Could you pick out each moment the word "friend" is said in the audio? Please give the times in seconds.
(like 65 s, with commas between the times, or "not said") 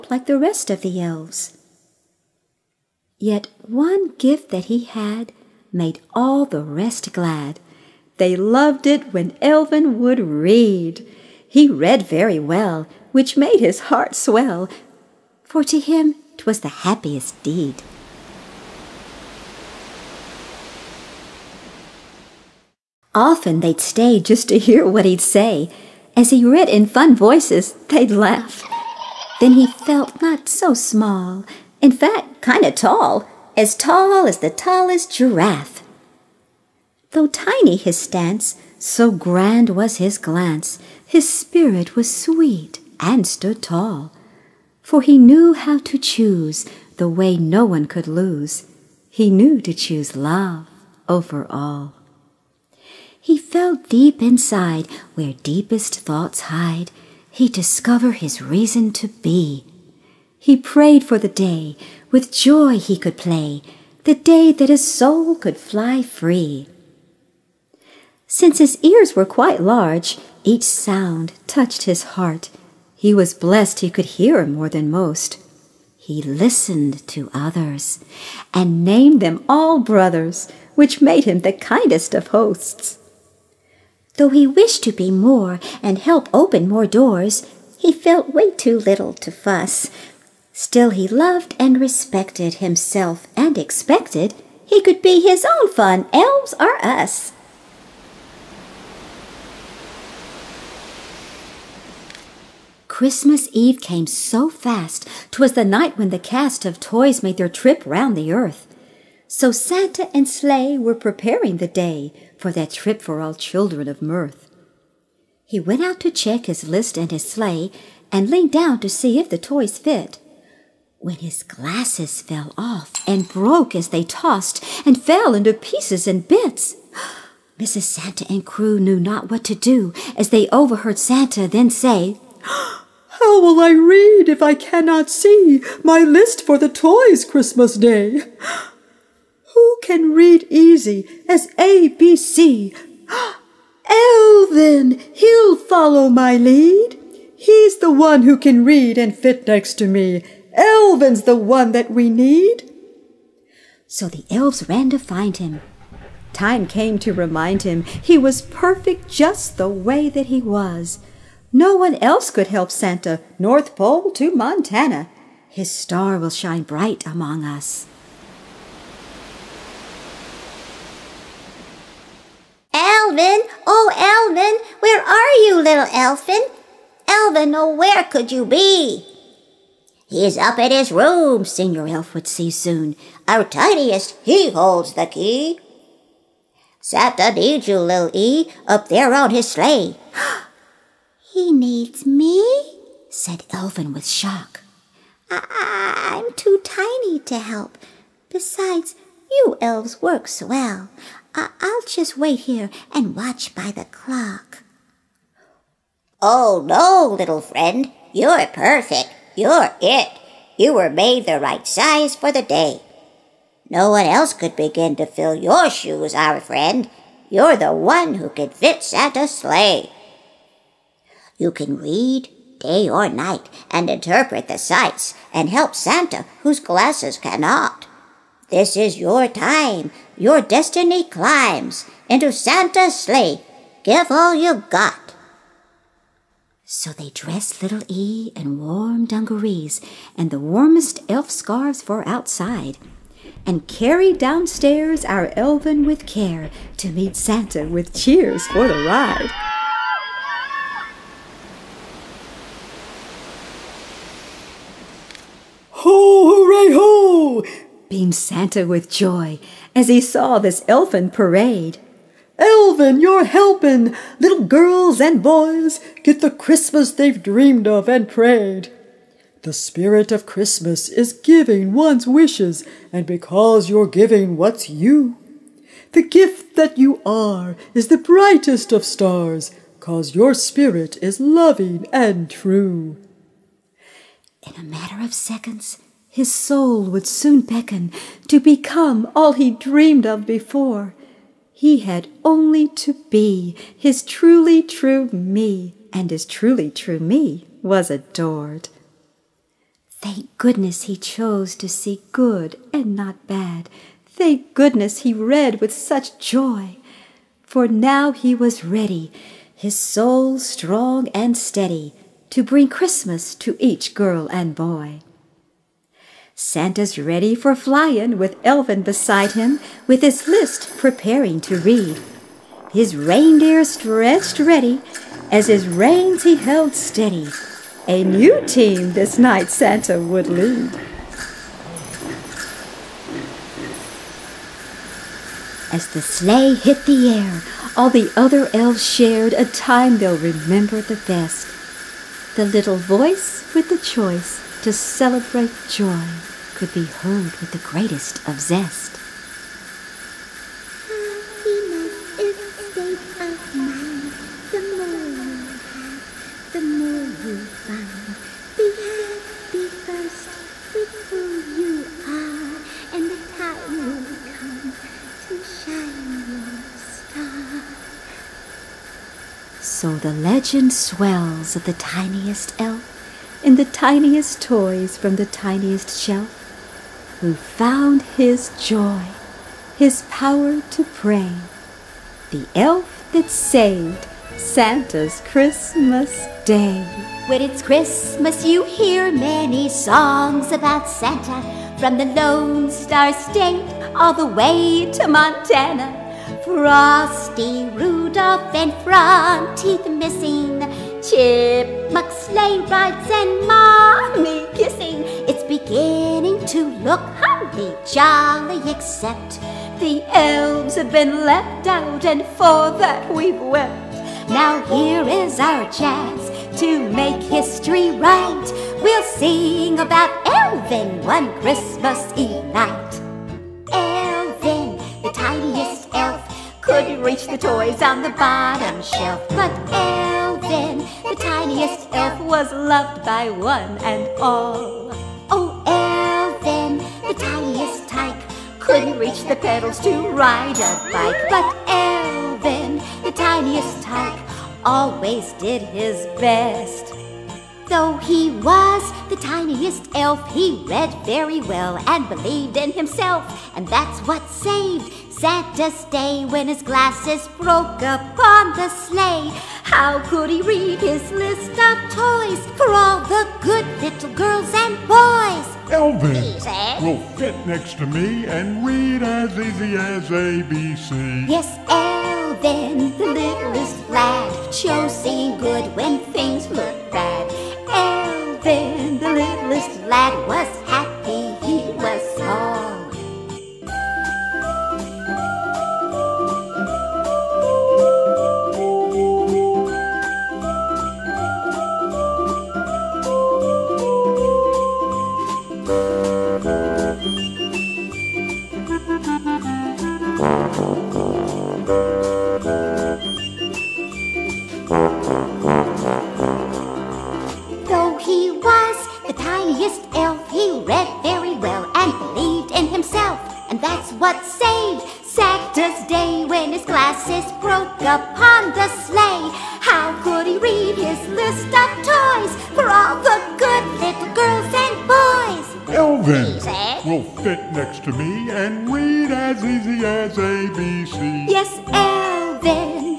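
207 s, 216 s.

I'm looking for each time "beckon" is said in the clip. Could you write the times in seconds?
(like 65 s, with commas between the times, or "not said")
287 s.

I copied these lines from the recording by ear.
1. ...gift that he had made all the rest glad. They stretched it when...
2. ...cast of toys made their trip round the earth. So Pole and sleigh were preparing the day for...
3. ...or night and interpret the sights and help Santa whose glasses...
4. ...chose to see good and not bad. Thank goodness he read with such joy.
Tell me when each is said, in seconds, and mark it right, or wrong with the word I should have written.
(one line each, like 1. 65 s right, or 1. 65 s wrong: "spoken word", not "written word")
1. 4 s wrong: "loved", not "stretched"
2. 106 s wrong: "Santa", not "Pole"
3. 222 s right
4. 300 s right.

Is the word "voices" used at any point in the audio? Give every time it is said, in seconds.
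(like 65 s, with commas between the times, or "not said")
27 s, 342 s.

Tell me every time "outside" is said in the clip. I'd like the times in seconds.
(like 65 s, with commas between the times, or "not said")
242 s.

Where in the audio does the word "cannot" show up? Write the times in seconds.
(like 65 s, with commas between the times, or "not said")
134 s, 227 s.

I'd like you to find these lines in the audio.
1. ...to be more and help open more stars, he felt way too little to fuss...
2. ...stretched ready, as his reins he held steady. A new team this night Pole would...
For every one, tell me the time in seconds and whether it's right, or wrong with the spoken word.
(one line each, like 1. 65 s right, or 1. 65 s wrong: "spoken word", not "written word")
1. 84 s wrong: "doors", not "stars"
2. 323 s wrong: "Santa", not "Pole".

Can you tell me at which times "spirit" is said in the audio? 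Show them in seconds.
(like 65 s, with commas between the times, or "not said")
41 s, 269 s, 280 s.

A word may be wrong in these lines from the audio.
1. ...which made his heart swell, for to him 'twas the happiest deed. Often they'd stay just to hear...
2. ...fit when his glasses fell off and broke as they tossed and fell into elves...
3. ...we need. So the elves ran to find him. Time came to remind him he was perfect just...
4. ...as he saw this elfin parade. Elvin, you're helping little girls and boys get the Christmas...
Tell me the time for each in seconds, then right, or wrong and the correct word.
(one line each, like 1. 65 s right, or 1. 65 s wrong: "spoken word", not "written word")
1. 13 s right
2. 119 s wrong: "pieces", not "elves"
3. 151 s right
4. 259 s right.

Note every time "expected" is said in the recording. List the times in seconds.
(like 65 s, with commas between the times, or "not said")
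93 s.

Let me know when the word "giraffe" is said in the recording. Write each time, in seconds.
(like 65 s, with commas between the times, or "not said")
35 s.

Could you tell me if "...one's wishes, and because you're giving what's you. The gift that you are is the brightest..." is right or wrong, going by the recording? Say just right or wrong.
right.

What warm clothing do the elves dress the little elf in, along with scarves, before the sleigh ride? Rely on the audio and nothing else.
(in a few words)
dungarees.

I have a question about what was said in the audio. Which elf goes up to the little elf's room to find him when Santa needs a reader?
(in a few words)
Senior Elf.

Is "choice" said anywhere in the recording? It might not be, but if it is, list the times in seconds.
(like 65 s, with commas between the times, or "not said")
343 s.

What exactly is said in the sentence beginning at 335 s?
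As the sleigh hit the air, all the other elves shared a time they'll remember the best.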